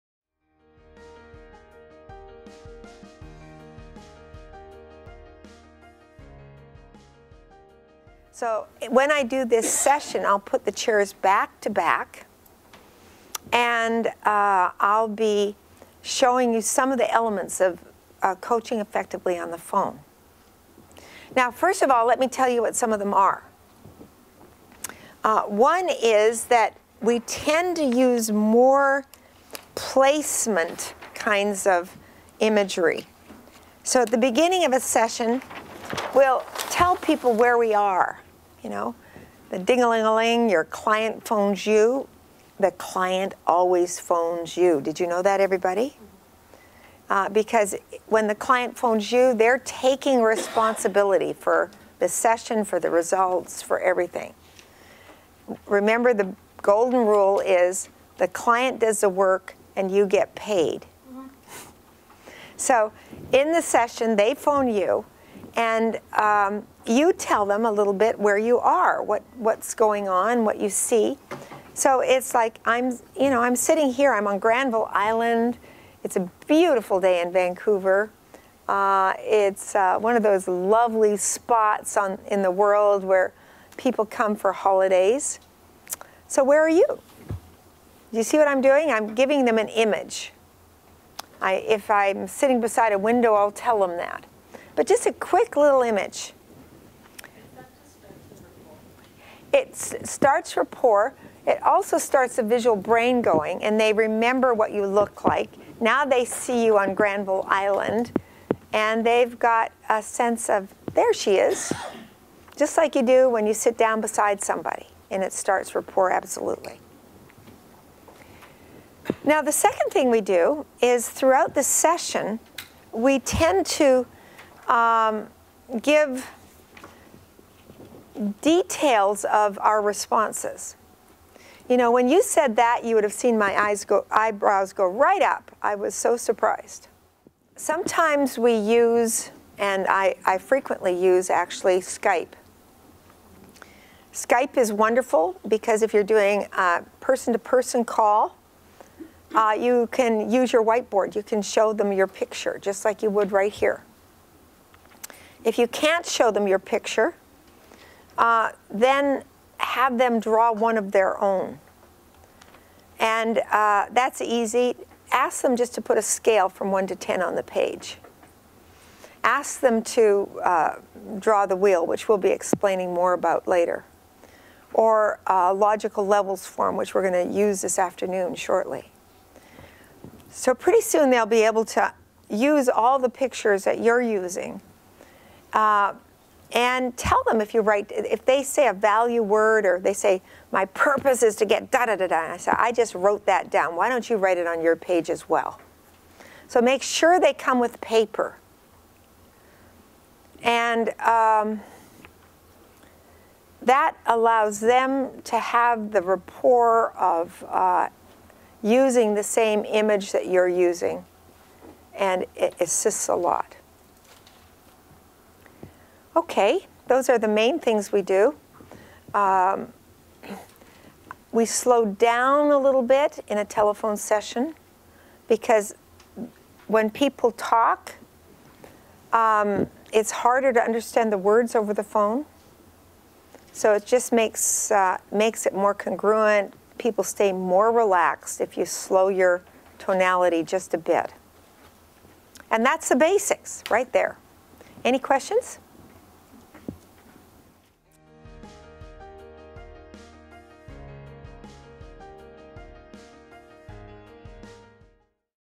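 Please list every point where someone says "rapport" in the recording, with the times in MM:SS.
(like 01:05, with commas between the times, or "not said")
01:40, 01:55, 03:26.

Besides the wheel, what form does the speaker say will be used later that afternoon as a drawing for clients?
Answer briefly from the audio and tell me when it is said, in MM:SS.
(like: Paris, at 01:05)
logical levels form, at 02:55.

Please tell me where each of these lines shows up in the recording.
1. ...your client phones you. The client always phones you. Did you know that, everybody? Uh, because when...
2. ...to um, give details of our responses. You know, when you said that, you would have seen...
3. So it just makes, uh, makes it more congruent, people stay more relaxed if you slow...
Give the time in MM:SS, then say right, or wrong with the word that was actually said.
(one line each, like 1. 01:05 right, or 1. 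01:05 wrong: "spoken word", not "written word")
1. 00:40 right
2. 02:03 right
3. 03:53 right.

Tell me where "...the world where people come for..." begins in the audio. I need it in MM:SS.
01:22.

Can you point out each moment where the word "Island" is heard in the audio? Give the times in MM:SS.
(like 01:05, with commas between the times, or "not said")
01:14, 01:47.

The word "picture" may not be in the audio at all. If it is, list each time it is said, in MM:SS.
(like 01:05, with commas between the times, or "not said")
02:32, 02:36, 03:03.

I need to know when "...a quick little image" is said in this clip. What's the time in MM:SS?
01:35.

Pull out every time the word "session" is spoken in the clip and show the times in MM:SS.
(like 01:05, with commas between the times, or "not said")
00:09, 00:34, 00:52, 01:03, 02:01, 03:43.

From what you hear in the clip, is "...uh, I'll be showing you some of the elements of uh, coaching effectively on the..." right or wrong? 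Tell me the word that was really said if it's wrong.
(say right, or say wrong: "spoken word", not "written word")
right.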